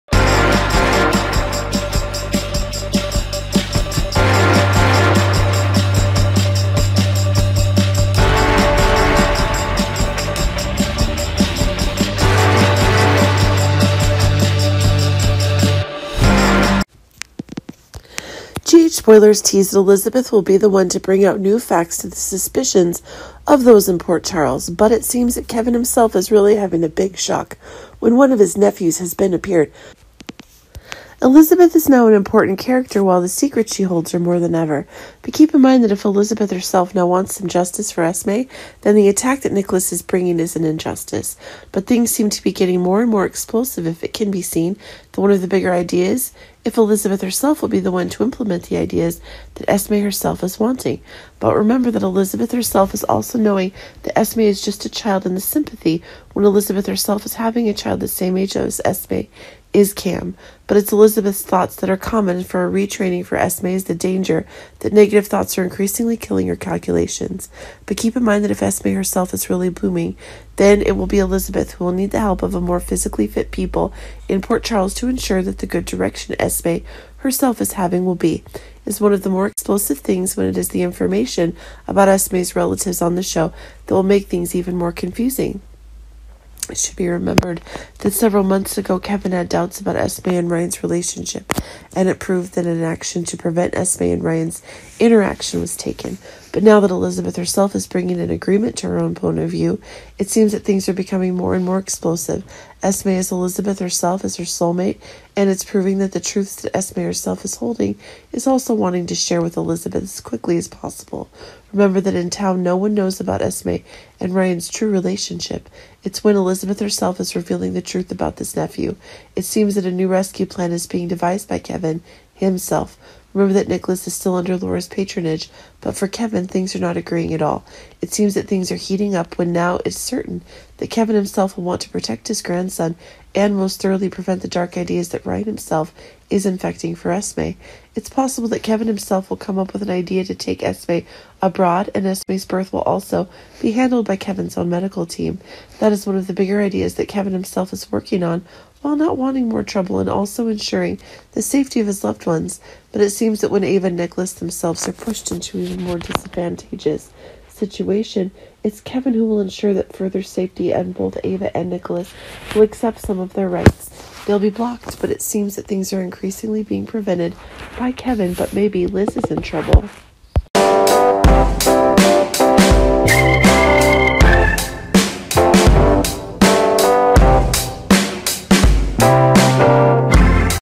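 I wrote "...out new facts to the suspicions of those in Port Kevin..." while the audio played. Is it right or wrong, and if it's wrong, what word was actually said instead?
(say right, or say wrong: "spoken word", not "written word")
wrong: "Charles", not "Kevin".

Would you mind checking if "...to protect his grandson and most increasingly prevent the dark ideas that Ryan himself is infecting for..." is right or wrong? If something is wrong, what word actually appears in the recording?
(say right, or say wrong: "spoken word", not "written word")
wrong: "thoroughly", not "increasingly".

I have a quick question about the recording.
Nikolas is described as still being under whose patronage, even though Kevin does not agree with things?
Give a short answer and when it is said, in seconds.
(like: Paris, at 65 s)
Laura, at 124 s.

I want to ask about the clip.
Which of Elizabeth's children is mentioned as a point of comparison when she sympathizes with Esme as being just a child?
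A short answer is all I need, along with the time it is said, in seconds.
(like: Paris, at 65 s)
Cam, at 59 s.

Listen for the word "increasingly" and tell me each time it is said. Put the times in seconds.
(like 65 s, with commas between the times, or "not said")
65 s, 166 s.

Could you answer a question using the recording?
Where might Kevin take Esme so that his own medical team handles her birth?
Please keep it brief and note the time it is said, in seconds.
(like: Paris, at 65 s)
Abroad, at 141 s.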